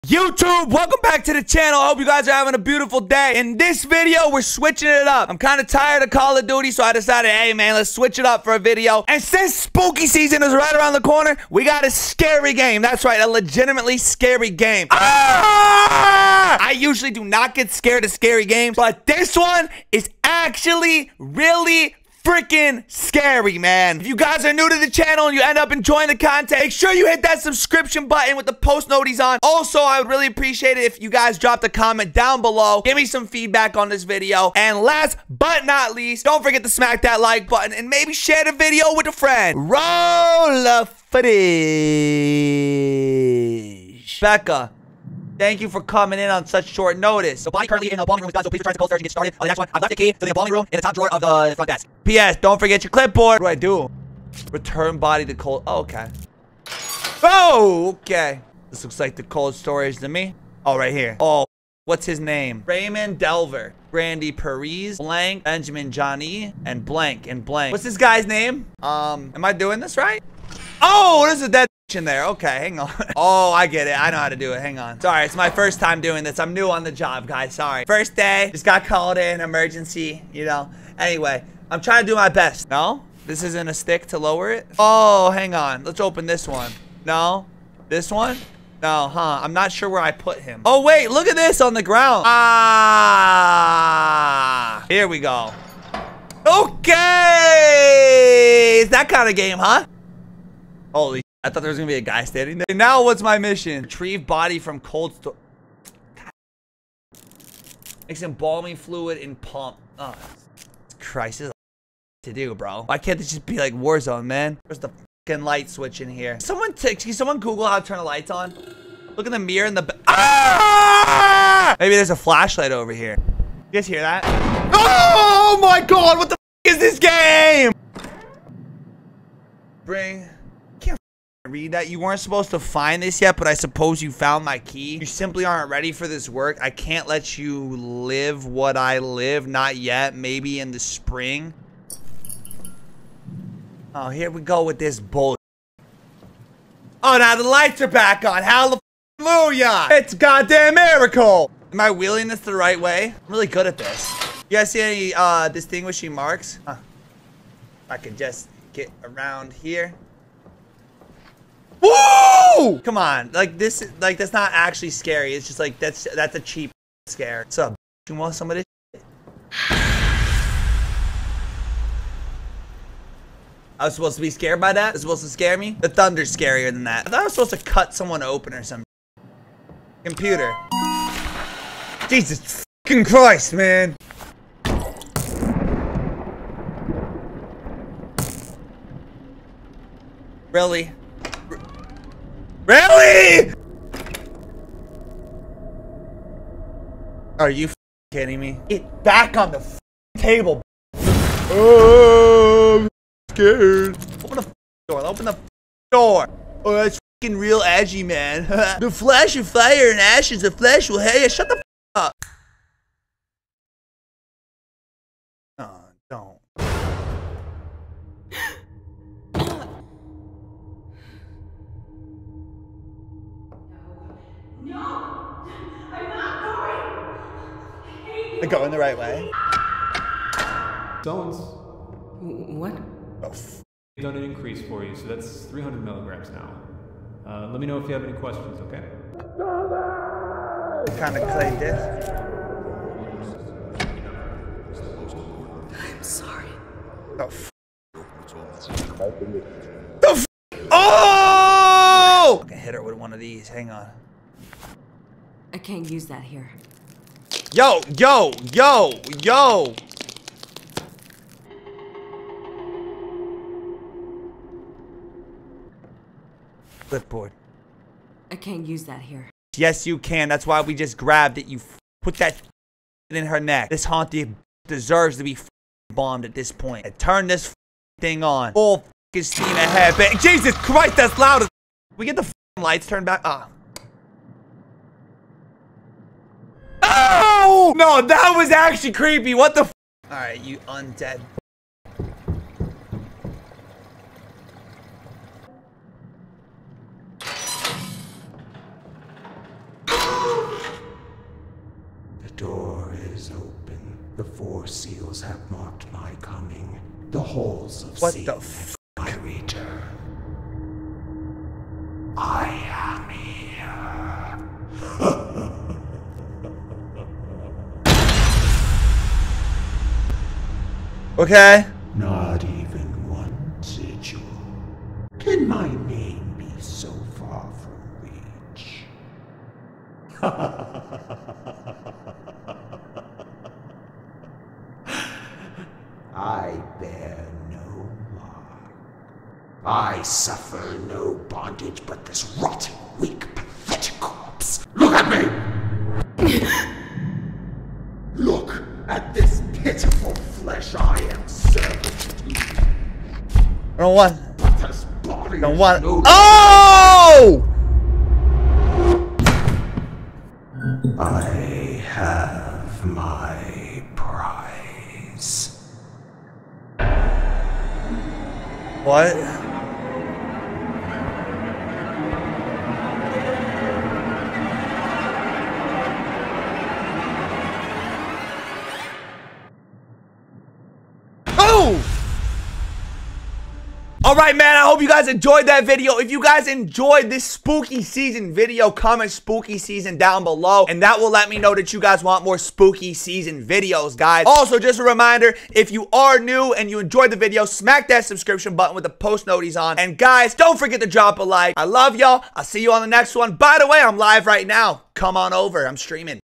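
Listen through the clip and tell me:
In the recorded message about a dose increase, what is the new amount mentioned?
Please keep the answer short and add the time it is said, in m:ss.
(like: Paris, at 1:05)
300 milligrams, at 3:55.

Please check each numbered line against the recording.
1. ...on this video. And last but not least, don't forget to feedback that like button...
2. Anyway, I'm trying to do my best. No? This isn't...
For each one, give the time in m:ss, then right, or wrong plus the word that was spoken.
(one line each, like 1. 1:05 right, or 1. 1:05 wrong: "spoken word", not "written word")
1. 0:33 wrong: "smack", not "feedback"
2. 1:20 right.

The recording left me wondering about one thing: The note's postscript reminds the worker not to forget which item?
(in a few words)
Clipboard.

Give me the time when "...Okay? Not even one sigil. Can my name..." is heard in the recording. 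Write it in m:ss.
5:21.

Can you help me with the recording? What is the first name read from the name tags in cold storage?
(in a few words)
Raymond Delver.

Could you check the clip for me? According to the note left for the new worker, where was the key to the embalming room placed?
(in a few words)
Top drawer of the front desk.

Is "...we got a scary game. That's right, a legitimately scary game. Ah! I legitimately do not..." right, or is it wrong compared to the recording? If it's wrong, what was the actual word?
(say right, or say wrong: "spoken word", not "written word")
wrong: "usually", not "legitimately".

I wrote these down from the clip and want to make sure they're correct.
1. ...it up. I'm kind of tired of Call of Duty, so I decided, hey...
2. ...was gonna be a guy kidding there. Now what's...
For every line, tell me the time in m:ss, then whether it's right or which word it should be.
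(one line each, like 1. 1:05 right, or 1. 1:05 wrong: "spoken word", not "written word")
1. 0:04 right
2. 1:41 wrong: "standing", not "kidding".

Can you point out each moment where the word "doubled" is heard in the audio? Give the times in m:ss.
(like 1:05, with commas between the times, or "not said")
not said.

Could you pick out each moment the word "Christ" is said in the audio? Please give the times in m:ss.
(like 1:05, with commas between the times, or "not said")
3:03, 4:40.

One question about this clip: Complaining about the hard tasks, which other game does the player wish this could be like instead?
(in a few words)
Warzone.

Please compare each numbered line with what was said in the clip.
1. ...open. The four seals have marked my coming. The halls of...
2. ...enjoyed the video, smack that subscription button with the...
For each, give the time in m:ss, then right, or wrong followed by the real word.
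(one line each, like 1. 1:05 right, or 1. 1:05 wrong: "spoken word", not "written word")
1. 5:03 right
2. 6:36 right.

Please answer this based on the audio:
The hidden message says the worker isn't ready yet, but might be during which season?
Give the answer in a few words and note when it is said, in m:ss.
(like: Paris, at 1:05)
Spring, at 2:20.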